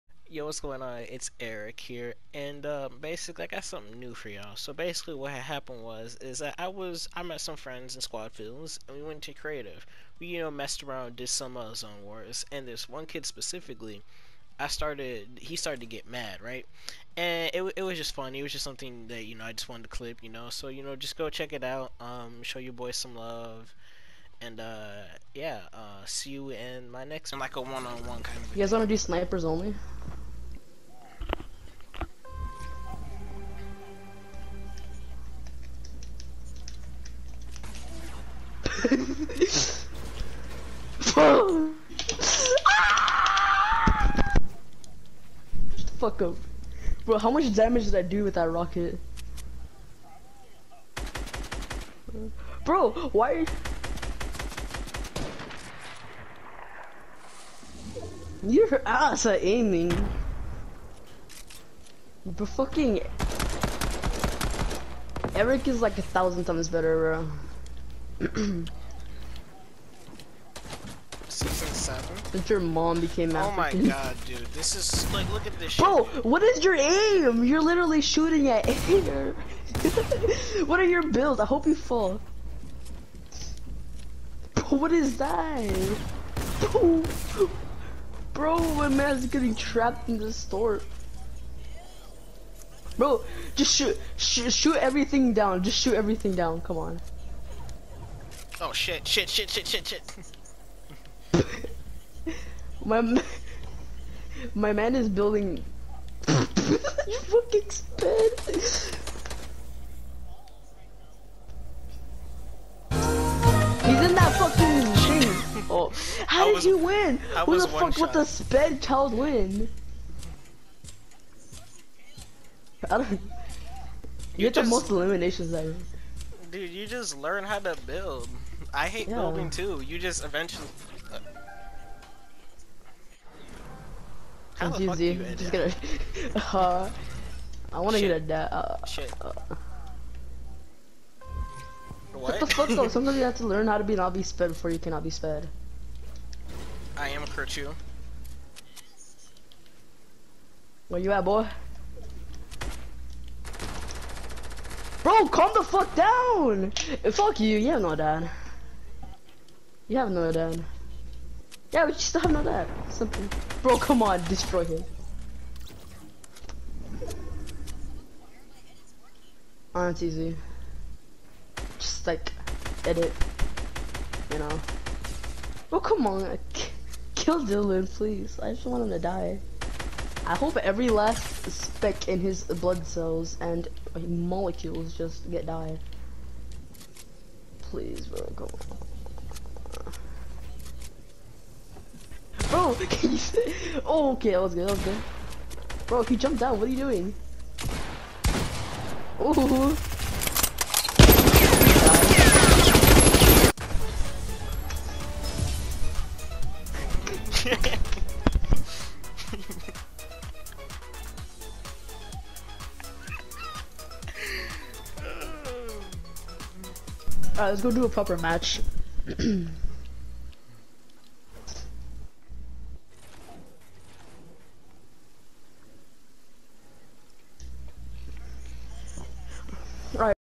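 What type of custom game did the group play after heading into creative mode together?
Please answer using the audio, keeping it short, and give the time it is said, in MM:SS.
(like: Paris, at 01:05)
zone wars, at 00:11.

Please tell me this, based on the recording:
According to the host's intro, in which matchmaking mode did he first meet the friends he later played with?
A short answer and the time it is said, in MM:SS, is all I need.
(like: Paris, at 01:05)
squad fills, at 00:08.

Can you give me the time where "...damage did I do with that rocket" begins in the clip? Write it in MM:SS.
00:47.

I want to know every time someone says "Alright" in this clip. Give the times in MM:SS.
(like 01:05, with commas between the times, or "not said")
03:37.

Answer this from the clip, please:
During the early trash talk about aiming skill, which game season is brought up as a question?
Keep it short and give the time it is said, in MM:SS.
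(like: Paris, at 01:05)
Season 7, at 01:11.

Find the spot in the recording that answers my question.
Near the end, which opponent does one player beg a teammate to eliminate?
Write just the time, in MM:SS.
02:57.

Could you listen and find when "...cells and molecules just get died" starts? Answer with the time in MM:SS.
03:02.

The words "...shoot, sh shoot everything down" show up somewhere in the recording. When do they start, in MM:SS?
01:33.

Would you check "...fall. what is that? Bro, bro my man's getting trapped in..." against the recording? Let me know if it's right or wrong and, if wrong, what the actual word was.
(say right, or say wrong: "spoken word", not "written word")
right.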